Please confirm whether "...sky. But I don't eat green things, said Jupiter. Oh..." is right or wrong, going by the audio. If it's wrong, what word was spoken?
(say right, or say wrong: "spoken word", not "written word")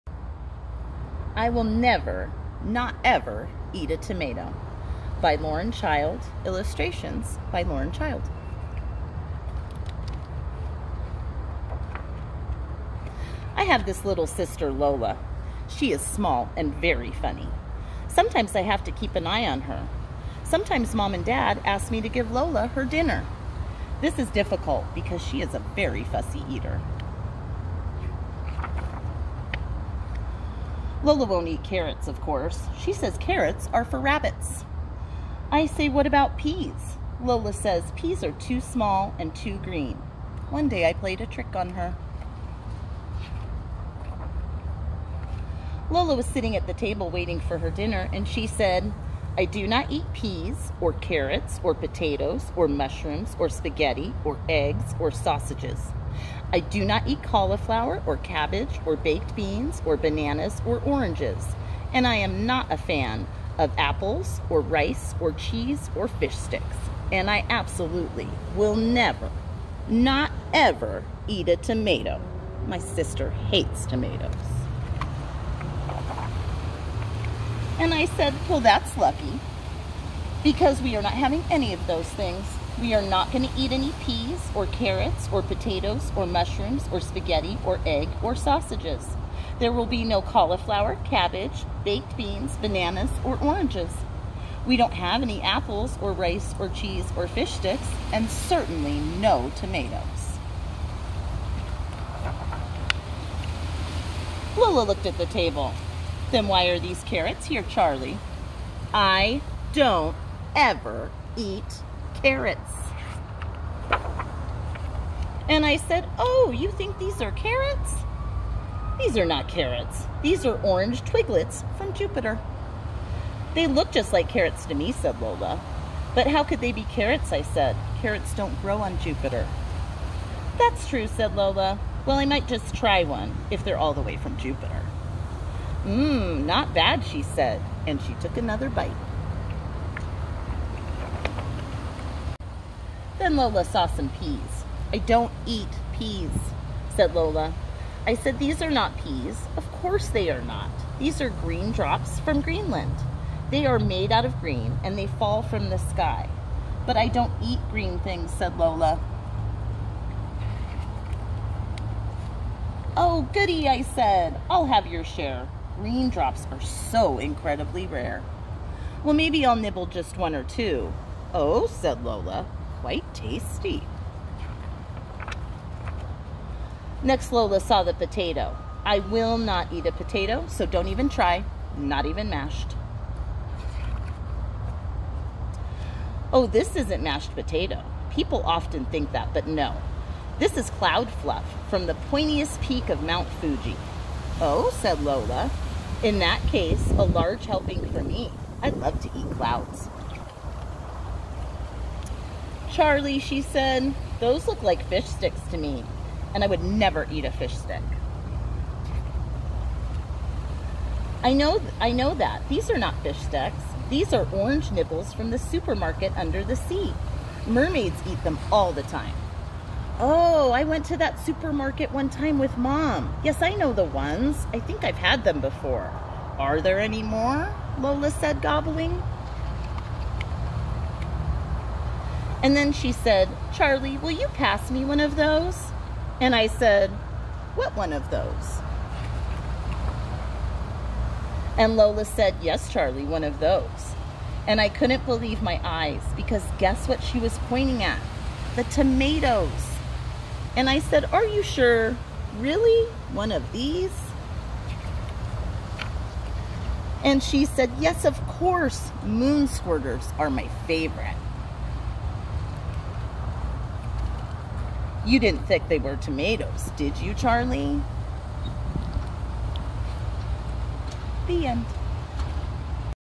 wrong: "Lola", not "Jupiter".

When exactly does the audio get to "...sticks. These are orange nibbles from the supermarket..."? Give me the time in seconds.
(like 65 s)
213 s.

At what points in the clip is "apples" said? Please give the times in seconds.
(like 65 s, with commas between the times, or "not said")
63 s, 95 s.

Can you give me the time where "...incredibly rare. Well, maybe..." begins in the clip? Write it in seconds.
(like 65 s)
167 s.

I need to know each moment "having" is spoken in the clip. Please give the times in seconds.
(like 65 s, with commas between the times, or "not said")
81 s.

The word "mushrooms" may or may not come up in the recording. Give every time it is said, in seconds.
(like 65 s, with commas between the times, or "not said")
52 s, 86 s.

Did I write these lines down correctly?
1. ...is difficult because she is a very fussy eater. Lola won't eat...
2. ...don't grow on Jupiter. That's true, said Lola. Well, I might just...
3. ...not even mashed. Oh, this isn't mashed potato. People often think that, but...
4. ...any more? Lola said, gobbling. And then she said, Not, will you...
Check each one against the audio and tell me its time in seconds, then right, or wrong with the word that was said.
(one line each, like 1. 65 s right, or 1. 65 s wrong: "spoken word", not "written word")
1. 24 s right
2. 128 s right
3. 181 s right
4. 226 s wrong: "Charlie", not "Not".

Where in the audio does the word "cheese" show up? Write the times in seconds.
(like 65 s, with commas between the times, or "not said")
65 s, 96 s.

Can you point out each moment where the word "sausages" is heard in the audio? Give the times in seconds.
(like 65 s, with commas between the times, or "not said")
55 s, 88 s.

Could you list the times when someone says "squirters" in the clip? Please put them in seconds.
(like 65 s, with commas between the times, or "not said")
259 s.